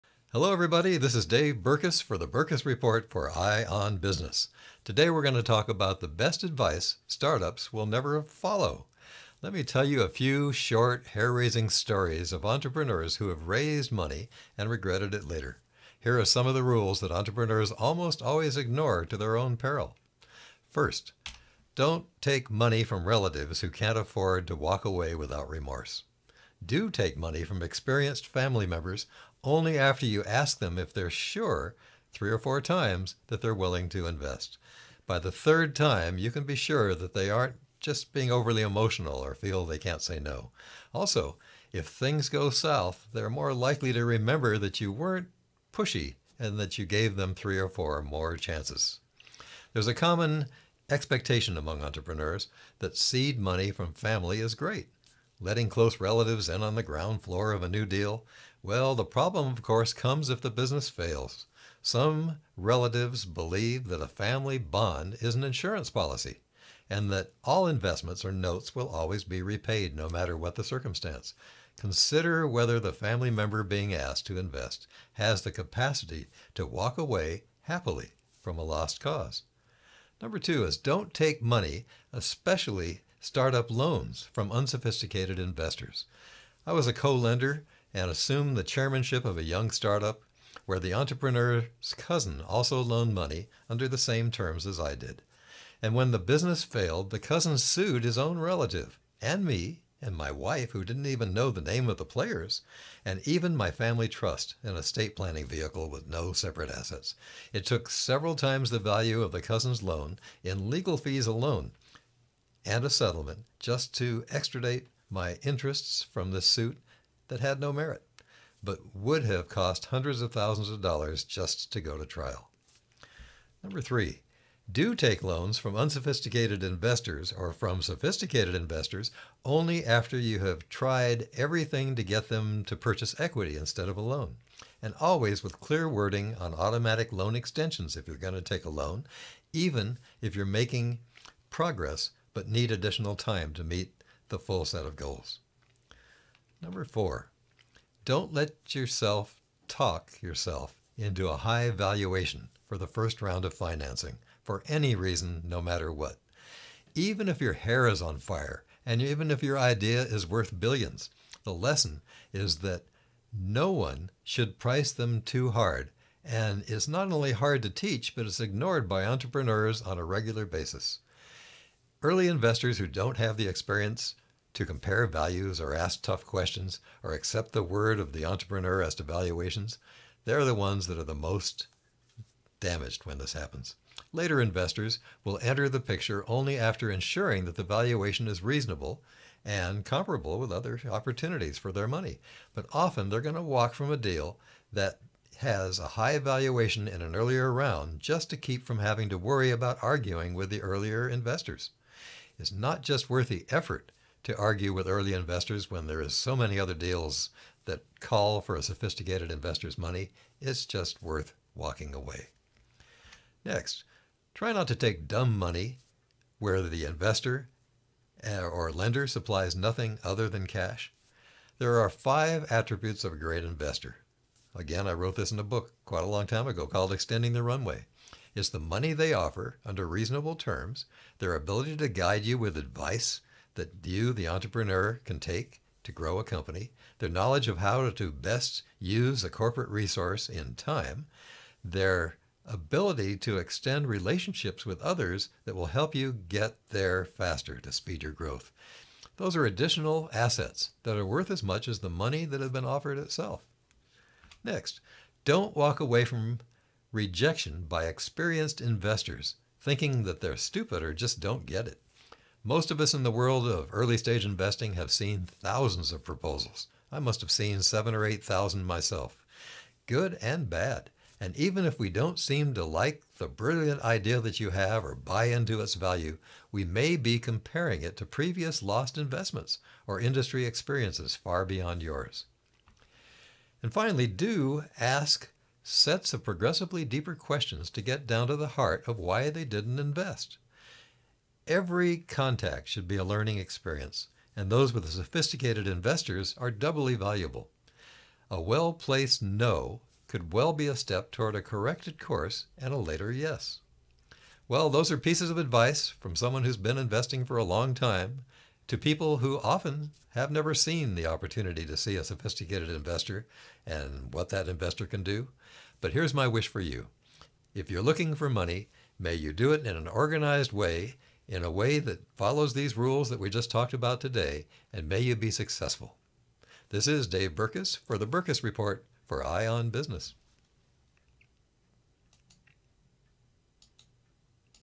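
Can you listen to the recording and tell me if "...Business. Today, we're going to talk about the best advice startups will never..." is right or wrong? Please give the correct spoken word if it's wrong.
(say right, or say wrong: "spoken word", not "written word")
right.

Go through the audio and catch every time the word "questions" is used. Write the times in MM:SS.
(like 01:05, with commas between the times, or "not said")
02:56, 04:47.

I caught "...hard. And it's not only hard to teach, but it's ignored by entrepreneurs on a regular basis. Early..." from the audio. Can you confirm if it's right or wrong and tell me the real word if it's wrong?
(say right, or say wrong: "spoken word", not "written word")
right.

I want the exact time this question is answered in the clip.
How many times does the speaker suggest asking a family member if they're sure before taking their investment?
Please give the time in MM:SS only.
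00:32.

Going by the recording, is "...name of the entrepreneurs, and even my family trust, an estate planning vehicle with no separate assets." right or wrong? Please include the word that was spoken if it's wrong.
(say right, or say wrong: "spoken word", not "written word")
wrong: "players", not "entrepreneurs".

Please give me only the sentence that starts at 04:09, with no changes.
Those are additional assets that are worth as much as the money that has been offered itself.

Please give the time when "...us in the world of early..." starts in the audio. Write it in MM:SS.
04:22.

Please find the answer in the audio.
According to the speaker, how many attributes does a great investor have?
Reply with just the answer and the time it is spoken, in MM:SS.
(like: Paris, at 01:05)
5, at 03:41.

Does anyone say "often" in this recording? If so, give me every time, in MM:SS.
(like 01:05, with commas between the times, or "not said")
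03:12, 05:09.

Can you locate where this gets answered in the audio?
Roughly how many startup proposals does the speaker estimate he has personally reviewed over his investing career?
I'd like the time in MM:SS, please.
04:27.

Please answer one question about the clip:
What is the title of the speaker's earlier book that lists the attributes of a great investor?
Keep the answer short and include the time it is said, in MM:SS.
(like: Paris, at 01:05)
Extending the Runway, at 03:46.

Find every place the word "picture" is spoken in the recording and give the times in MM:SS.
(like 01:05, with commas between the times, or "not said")
03:05.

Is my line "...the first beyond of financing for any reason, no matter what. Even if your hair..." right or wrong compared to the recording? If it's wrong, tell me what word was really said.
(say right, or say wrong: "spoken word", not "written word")
wrong: "round", not "beyond".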